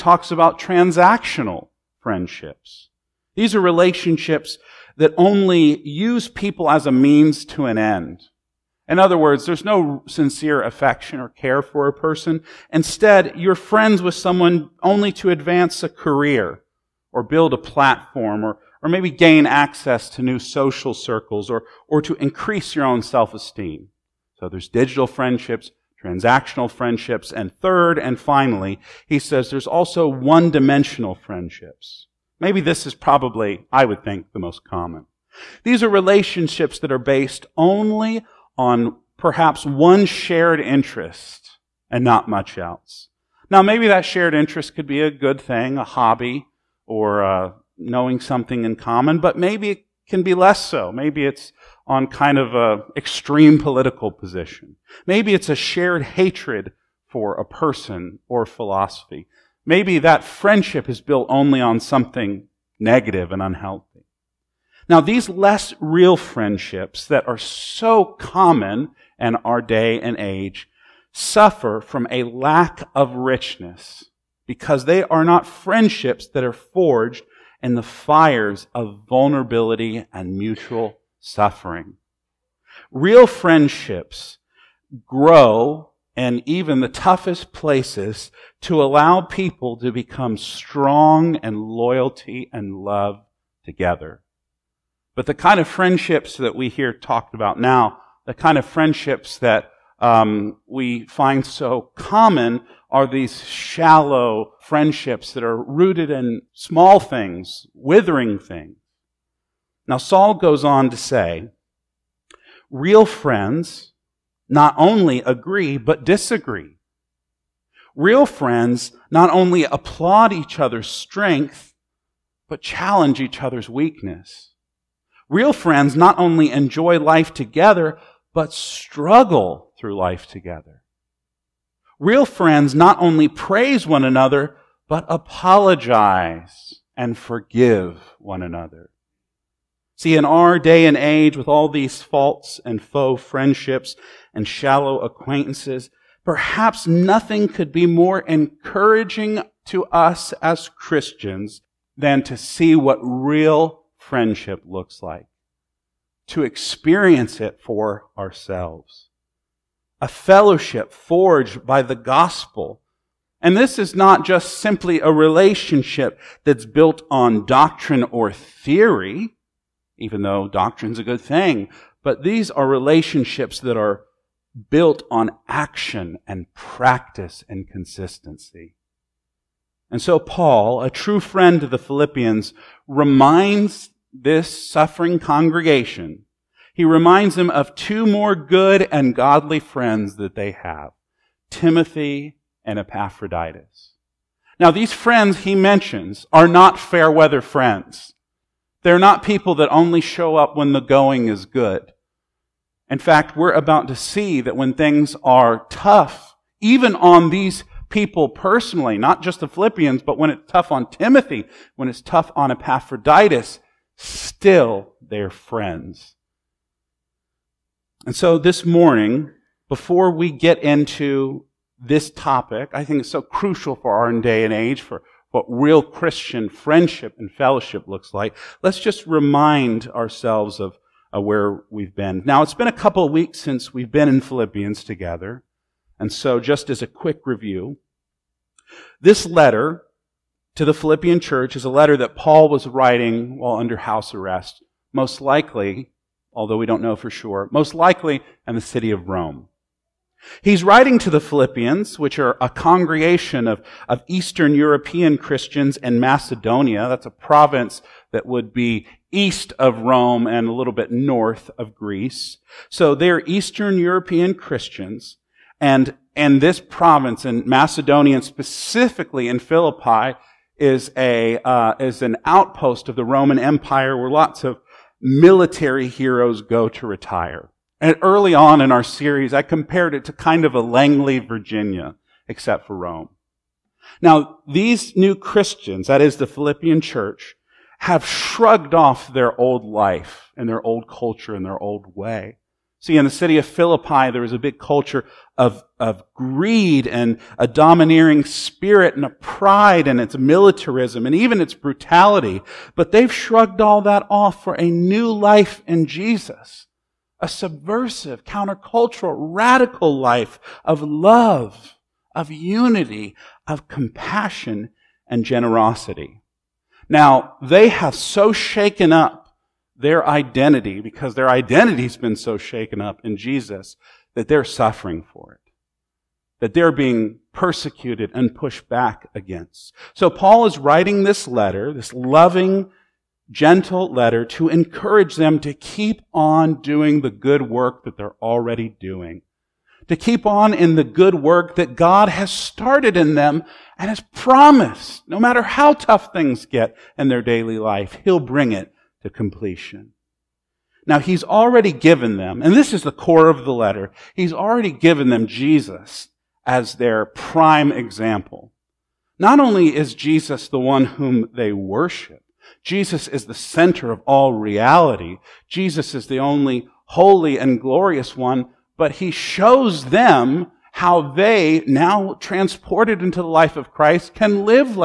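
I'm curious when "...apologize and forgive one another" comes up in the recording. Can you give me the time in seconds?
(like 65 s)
135 s.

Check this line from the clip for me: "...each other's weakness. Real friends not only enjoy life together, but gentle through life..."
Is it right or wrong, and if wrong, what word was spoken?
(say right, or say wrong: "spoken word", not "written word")
wrong: "struggle", not "gentle".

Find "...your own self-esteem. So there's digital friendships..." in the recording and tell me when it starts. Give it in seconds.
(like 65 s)
22 s.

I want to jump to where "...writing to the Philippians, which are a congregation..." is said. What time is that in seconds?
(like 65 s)
250 s.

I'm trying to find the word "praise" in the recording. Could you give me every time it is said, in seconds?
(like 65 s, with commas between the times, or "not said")
133 s.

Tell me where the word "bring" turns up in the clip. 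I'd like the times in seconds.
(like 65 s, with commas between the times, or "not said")
348 s.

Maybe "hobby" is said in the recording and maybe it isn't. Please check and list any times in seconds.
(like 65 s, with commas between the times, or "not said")
45 s.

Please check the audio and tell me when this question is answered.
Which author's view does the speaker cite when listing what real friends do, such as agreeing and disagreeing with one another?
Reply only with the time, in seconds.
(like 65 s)
109 s.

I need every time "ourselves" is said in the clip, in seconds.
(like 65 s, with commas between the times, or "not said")
158 s, 229 s.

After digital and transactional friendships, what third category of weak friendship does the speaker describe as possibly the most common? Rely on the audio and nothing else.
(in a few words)
one-dimensional friendships.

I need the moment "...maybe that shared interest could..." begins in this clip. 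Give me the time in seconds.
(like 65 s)
43 s.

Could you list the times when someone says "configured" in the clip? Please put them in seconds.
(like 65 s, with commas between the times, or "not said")
not said.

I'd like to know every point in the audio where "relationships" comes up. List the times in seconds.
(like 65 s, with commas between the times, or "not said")
3 s, 35 s, 165 s, 172 s.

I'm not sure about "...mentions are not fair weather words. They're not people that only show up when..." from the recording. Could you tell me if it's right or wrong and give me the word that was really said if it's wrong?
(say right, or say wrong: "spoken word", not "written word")
wrong: "friends", not "words".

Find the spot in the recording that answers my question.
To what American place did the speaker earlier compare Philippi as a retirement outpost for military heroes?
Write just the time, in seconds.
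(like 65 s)
280 s.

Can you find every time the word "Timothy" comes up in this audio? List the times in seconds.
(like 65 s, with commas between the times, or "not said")
191 s, 210 s.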